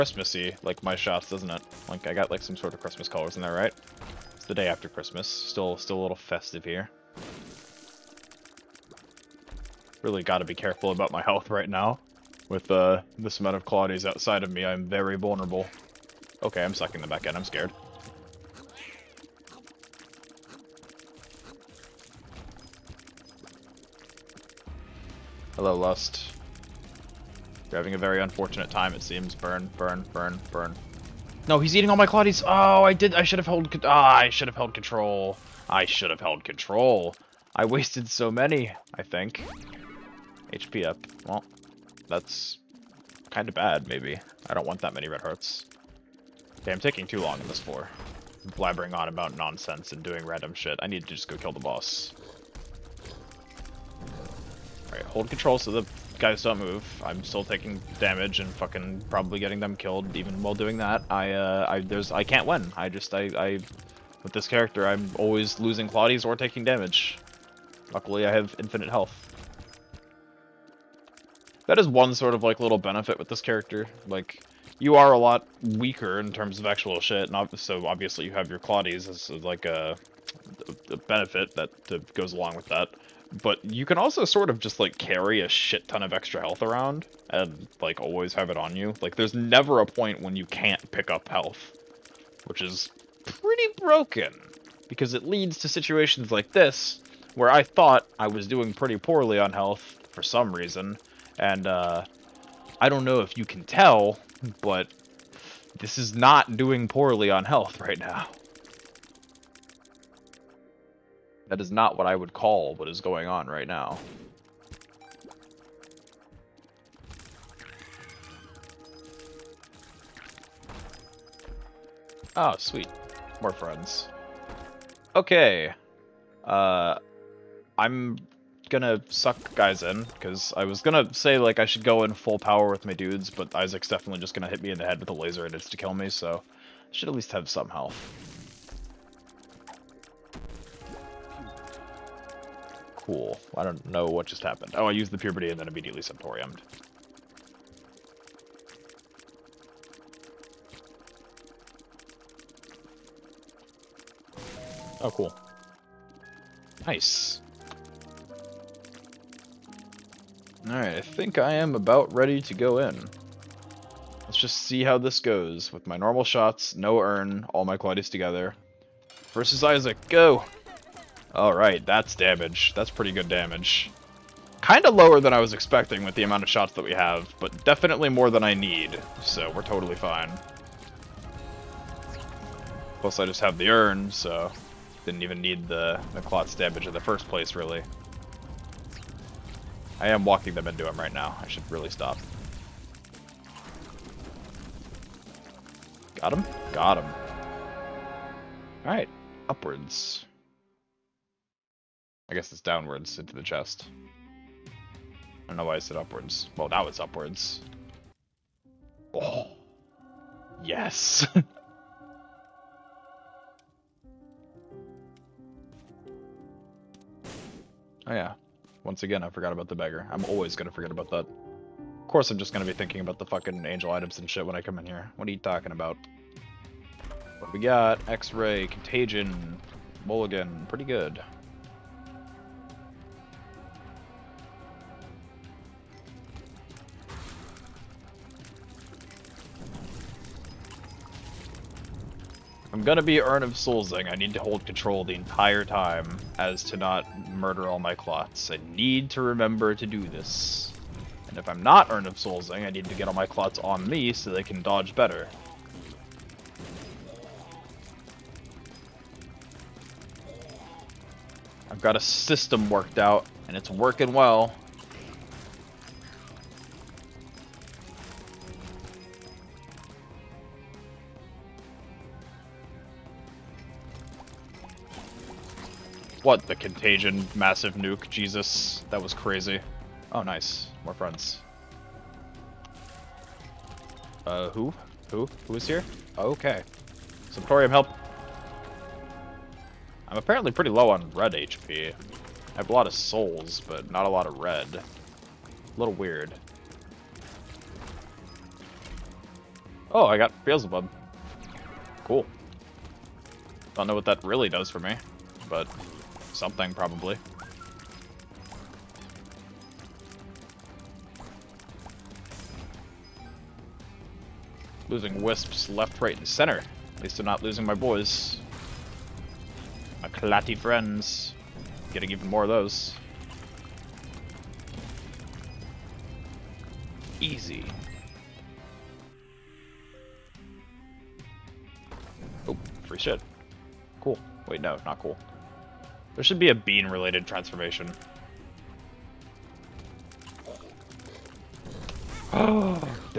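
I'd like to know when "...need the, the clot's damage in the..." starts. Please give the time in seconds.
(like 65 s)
185 s.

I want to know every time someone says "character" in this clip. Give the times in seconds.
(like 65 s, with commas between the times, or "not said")
64 s, 73 s.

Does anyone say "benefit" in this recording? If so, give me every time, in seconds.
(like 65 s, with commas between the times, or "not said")
72 s, 80 s.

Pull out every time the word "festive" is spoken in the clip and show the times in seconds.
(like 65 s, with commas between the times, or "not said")
6 s.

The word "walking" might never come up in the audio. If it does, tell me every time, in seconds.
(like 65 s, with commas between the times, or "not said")
190 s.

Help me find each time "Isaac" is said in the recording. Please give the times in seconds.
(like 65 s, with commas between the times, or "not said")
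133 s, 169 s.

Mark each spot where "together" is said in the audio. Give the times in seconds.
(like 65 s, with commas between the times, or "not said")
168 s.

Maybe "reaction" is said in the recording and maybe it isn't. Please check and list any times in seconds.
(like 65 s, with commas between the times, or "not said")
not said.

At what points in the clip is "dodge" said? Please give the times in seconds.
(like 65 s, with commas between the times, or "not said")
254 s.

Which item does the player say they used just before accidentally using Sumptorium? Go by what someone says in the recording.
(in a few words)
Puberty.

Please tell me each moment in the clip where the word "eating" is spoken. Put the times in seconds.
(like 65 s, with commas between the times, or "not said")
31 s.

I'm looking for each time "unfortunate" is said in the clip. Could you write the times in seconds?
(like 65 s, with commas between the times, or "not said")
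28 s.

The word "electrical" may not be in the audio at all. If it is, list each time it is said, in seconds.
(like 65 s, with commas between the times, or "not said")
not said.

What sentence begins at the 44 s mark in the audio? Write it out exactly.
I don't want that many red hearts.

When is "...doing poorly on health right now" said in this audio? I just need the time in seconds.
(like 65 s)
106 s.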